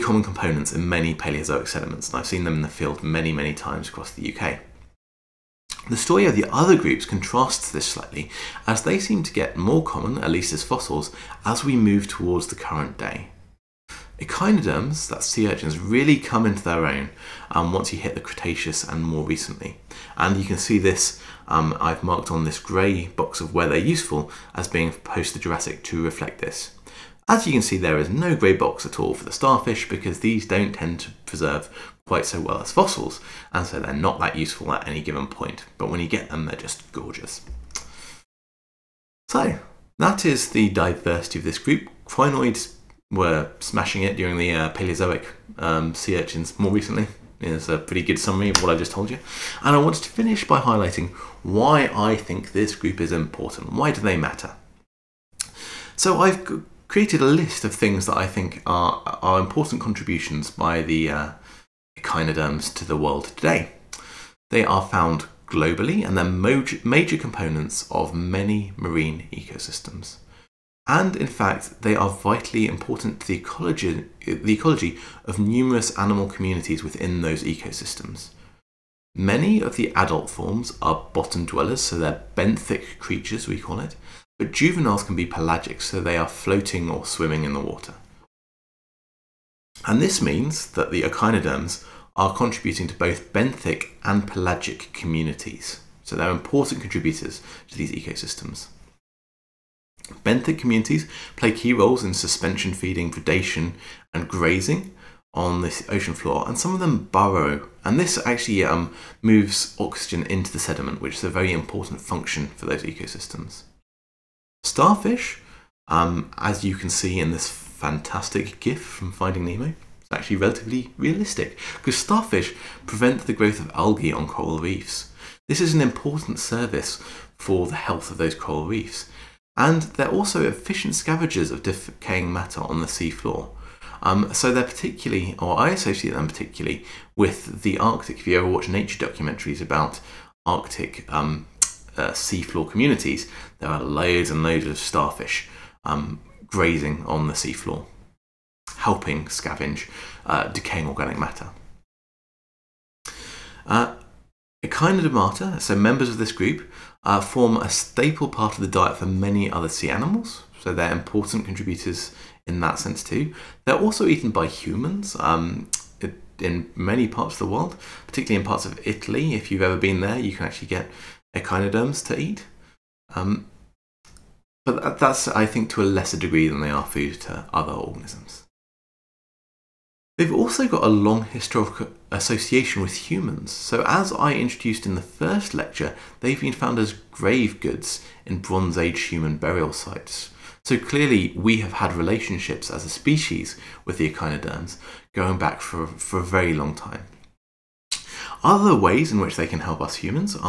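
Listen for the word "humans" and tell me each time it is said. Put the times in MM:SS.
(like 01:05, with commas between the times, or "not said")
02:44, 03:03, 03:09, 03:19.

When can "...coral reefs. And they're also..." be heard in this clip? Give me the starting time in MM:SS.
02:08.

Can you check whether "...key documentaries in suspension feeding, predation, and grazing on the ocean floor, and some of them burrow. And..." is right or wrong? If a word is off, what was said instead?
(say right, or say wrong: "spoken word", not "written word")
wrong: "roles", not "documentaries".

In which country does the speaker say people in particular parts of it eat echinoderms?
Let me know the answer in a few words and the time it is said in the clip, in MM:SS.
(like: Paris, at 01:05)
Italy, at 02:48.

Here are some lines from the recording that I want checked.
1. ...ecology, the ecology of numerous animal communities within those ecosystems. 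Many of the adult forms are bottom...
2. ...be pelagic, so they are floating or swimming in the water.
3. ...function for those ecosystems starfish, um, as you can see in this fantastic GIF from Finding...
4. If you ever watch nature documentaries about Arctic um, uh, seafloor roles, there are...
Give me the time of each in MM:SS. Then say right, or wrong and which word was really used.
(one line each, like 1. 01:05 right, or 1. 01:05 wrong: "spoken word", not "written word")
1. 01:13 right
2. 01:25 right
3. 01:52 right
4. 02:18 wrong: "communities", not "roles".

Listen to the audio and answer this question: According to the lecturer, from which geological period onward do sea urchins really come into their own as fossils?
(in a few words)
Cretaceous.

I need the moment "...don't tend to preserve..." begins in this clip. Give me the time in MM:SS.
00:30.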